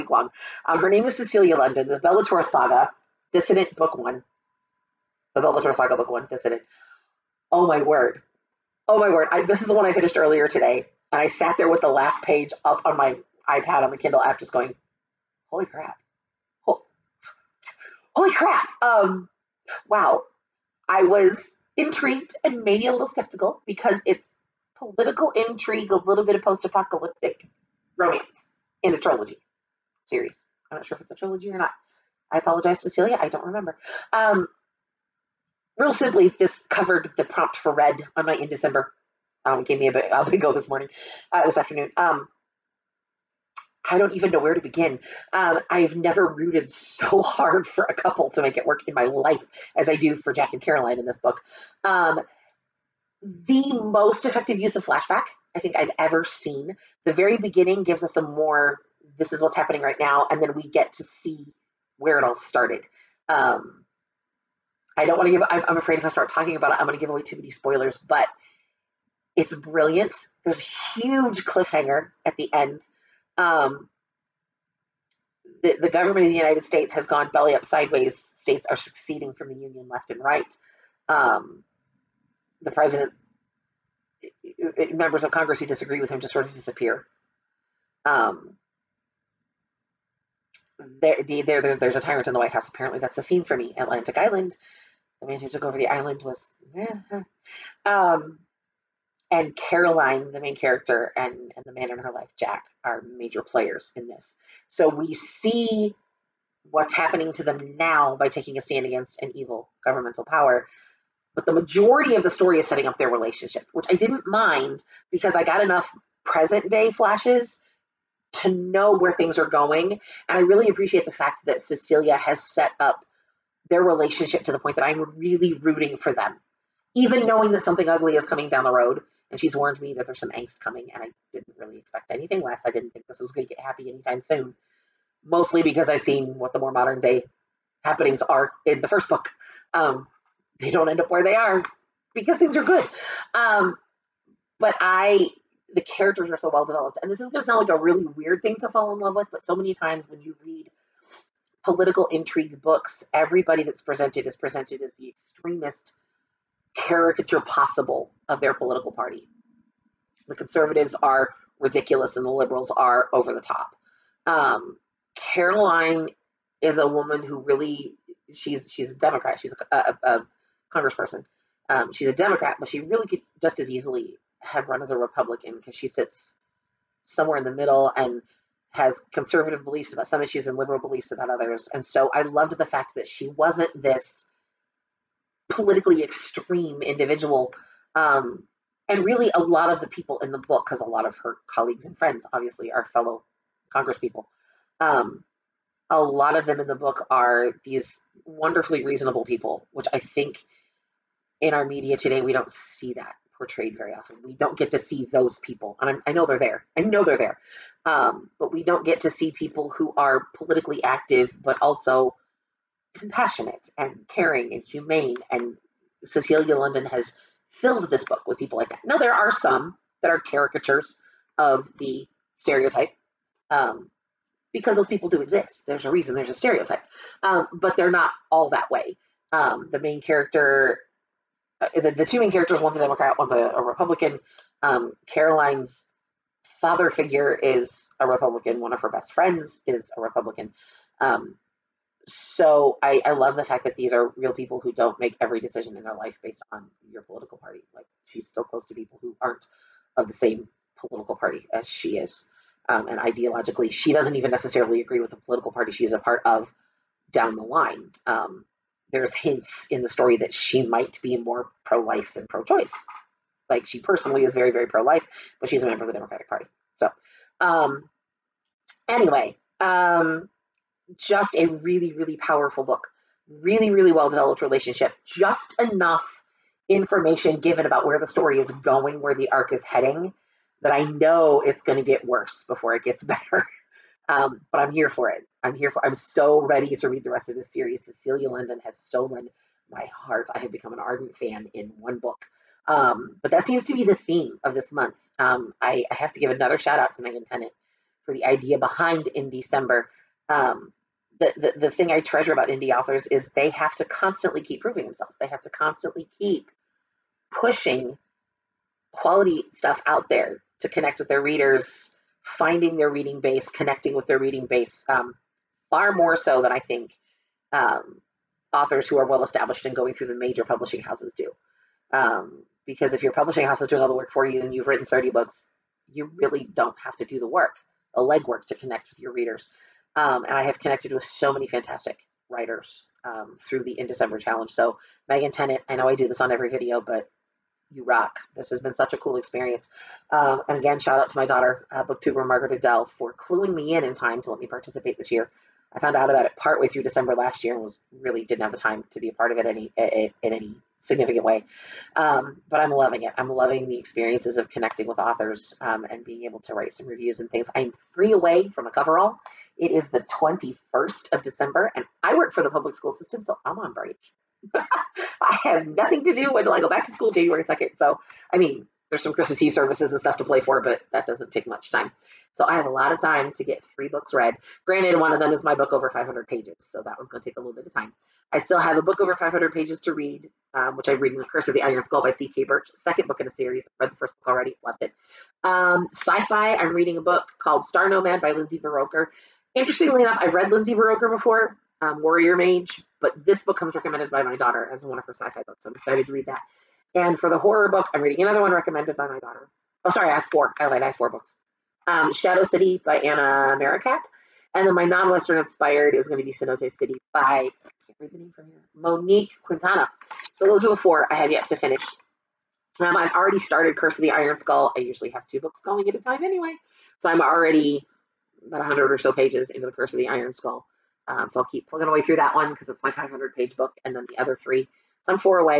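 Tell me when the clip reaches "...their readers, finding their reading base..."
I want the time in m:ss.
5:11.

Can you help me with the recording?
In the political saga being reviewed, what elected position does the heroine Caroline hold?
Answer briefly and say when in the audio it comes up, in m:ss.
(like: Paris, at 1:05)
Congressperson, at 2:50.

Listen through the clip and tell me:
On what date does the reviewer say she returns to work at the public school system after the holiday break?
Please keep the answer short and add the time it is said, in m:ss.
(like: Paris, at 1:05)
January 2, at 6:07.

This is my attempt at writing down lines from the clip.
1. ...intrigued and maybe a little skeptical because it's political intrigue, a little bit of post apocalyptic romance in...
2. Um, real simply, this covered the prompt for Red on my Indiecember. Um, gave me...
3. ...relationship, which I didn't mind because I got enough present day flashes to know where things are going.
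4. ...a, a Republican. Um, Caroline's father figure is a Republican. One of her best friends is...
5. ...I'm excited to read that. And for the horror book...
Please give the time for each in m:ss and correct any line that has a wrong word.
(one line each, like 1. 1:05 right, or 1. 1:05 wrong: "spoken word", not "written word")
1. 0:21 right
2. 0:34 right
3. 1:53 right
4. 3:53 right
5. 6:35 right.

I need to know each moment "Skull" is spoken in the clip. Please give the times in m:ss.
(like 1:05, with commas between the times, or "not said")
6:21, 6:54, 7:00.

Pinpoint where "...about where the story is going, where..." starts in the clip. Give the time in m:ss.
4:37.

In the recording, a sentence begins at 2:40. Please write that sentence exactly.
The conservatives are ridiculous and the liberals are over the top.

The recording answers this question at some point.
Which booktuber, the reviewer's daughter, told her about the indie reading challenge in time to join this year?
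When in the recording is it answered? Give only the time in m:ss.
5:42.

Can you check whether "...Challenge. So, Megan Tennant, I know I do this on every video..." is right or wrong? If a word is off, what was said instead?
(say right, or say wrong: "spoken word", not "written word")
right.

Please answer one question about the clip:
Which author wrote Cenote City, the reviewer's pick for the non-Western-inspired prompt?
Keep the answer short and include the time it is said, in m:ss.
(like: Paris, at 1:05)
Monique Quintana, at 6:48.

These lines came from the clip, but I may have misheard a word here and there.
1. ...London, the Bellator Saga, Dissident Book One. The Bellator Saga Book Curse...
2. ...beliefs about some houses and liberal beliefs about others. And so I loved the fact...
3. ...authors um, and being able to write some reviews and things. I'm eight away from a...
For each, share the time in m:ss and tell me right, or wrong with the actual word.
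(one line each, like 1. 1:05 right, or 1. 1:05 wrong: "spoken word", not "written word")
1. 0:01 wrong: "One", not "Curse"
2. 2:59 wrong: "issues", not "houses"
3. 5:54 wrong: "three", not "eight".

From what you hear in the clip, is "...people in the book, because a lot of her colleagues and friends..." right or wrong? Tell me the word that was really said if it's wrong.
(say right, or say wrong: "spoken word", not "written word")
right.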